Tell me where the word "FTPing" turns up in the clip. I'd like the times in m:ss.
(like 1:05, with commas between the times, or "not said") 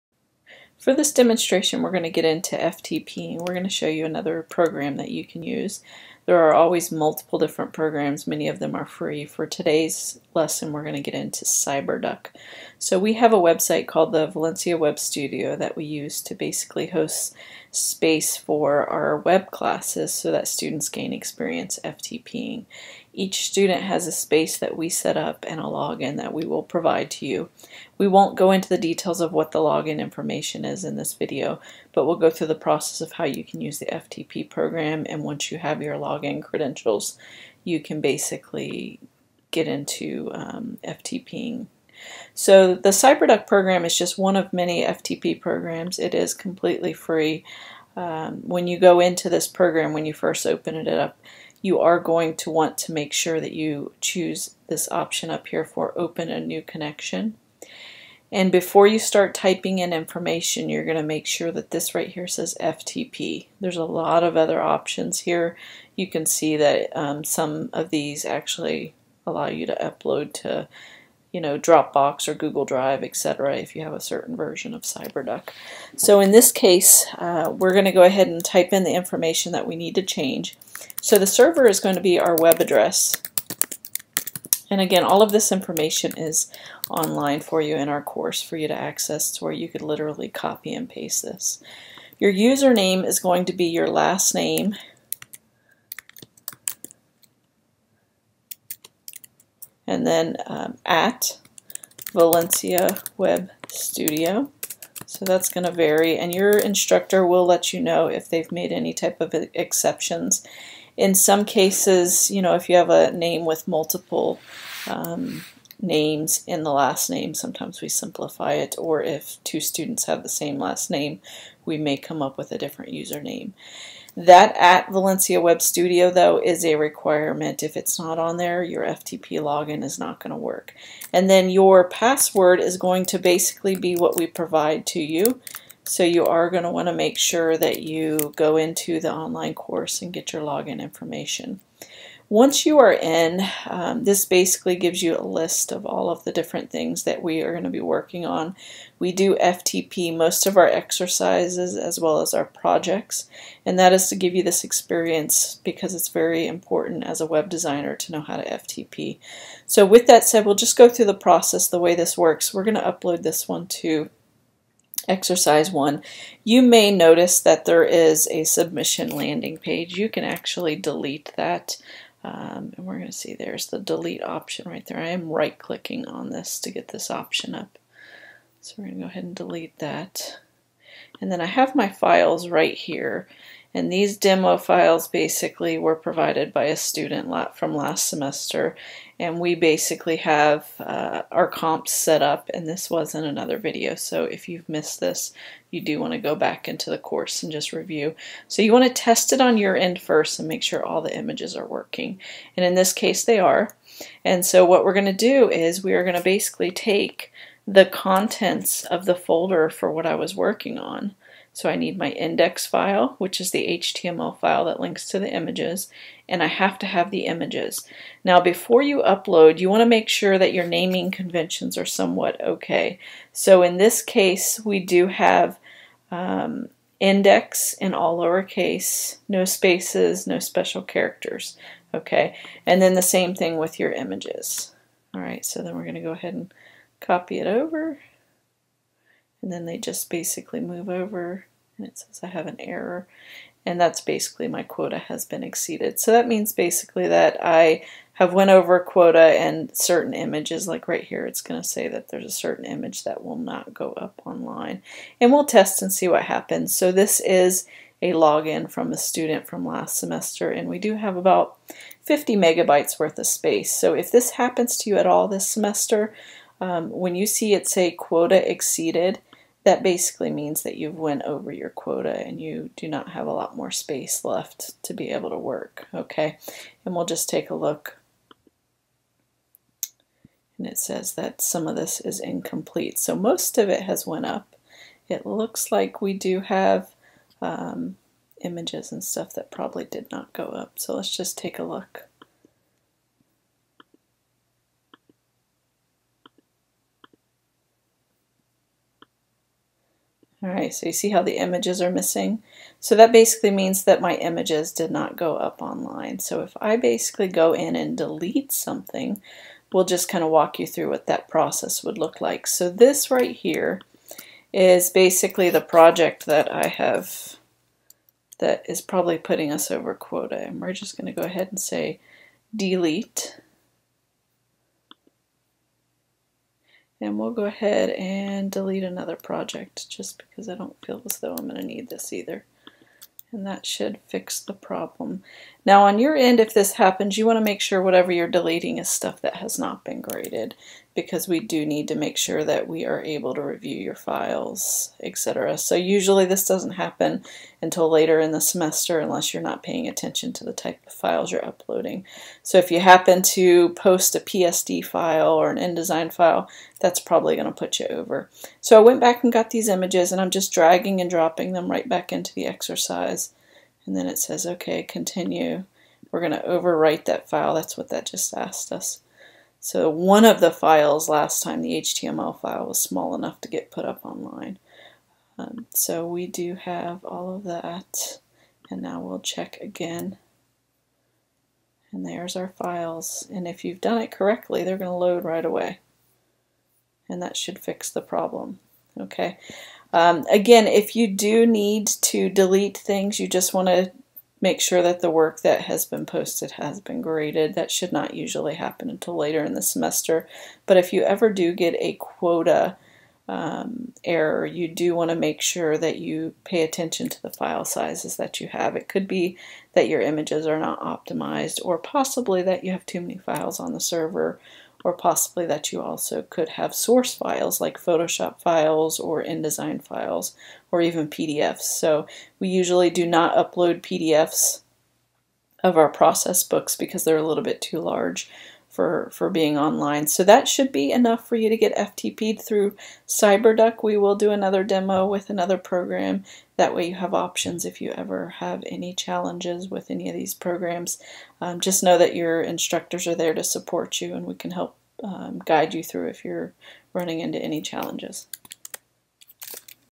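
0:21, 0:40.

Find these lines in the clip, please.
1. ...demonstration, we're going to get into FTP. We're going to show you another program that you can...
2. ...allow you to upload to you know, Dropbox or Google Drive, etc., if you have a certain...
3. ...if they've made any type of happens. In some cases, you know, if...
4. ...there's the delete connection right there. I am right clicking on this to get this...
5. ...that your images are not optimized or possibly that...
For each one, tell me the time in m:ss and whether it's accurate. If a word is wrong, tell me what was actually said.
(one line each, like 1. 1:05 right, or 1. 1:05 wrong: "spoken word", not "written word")
1. 0:01 right
2. 1:09 right
3. 1:48 wrong: "exceptions", not "happens"
4. 2:53 wrong: "option", not "connection"
5. 6:49 right.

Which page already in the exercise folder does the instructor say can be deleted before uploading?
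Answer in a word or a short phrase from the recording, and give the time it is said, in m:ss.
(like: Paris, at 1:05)
submission landing page, at 2:48.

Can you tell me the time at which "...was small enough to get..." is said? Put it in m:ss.
6:12.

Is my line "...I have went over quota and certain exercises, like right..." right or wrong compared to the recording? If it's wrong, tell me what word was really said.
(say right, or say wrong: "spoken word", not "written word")
wrong: "images", not "exercises".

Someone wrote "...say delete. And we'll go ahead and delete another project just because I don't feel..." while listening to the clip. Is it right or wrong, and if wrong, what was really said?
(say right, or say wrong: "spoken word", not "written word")
right.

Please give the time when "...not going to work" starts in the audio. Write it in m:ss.
2:09.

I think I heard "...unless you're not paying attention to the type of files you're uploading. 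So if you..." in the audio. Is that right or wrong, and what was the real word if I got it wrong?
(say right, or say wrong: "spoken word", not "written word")
right.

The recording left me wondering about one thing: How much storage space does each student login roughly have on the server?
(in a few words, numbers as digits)
50 megabytes.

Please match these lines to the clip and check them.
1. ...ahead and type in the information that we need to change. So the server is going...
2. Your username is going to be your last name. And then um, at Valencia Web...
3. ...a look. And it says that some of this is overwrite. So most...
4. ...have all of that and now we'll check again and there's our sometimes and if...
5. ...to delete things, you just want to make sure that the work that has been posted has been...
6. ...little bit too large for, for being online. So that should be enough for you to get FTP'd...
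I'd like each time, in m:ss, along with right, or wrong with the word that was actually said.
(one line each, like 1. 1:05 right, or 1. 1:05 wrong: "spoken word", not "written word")
1. 1:18 right
2. 1:32 right
3. 4:37 wrong: "incomplete", not "overwrite"
4. 6:16 wrong: "files", not "sometimes"
5. 6:31 right
6. 7:07 right.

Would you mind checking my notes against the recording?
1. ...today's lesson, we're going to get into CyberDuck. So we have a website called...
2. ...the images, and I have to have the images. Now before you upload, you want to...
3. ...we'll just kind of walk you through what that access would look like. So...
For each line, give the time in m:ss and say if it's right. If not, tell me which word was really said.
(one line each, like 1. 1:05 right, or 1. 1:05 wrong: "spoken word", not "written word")
1. 0:09 right
2. 3:35 right
3. 5:09 wrong: "process", not "access".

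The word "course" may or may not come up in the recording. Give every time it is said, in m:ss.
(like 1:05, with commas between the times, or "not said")
1:28, 2:19, 3:16.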